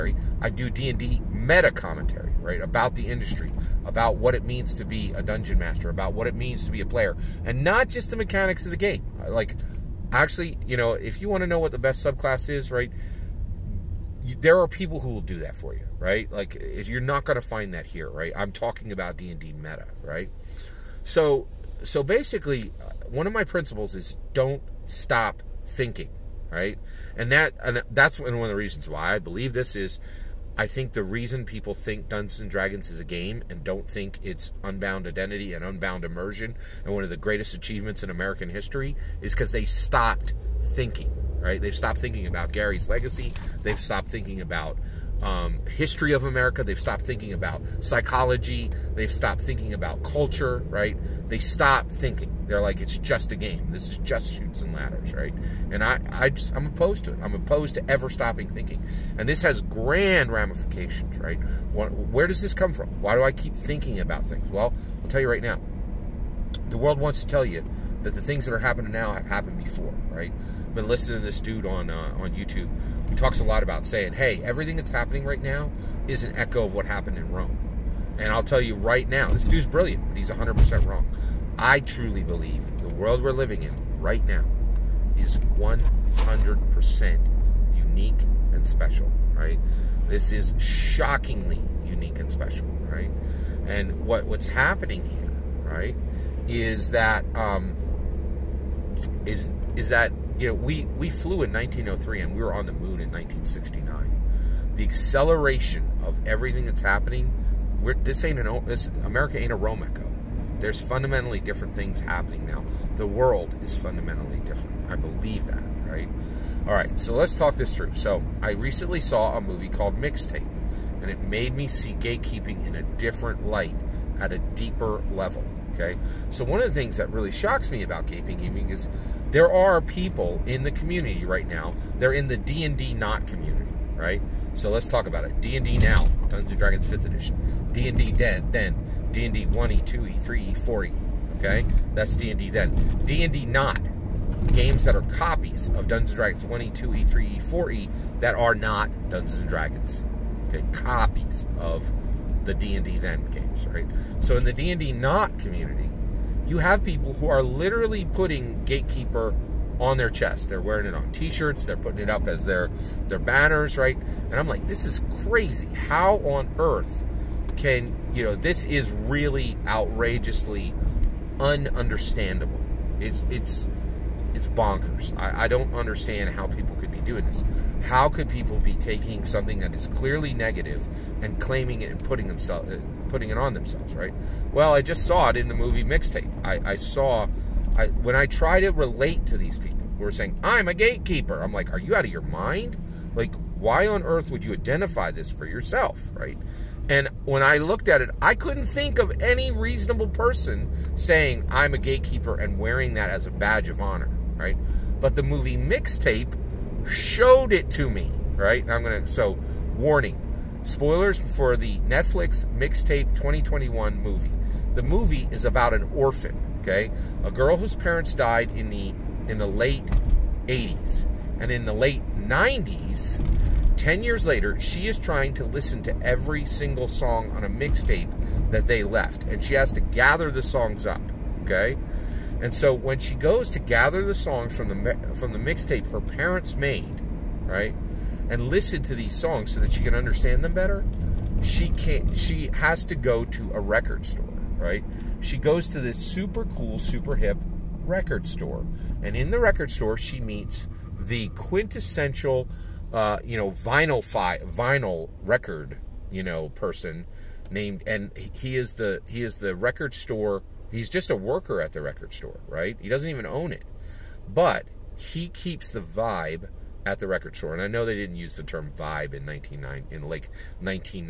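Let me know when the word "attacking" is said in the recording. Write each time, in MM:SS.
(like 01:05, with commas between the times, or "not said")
not said.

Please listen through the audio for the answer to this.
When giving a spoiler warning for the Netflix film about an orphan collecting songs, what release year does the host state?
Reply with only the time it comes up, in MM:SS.
03:33.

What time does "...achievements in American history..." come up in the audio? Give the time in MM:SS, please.
00:37.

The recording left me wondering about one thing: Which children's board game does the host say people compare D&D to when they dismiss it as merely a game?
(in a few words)
Chutes and Ladders.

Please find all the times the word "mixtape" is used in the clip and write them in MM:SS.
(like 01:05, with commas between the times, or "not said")
01:59, 03:05, 03:25, 03:32, 03:47, 03:55.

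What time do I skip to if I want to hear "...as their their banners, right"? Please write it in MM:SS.
02:42.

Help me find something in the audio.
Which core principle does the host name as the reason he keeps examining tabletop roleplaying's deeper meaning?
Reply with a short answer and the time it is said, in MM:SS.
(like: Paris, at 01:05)
Don't stop thinking, at 00:24.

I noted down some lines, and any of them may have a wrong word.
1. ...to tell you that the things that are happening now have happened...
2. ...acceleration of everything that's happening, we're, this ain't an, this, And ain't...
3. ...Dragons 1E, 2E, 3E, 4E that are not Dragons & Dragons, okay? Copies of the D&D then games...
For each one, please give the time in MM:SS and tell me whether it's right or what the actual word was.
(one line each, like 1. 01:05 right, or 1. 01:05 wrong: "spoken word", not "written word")
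1. 01:07 right
2. 01:44 wrong: "America", not "And"
3. 02:26 wrong: "Dungeons", not "Dragons".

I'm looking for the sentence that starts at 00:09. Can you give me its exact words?
Like, actually, you know, if you want to know what the best subclass is, right?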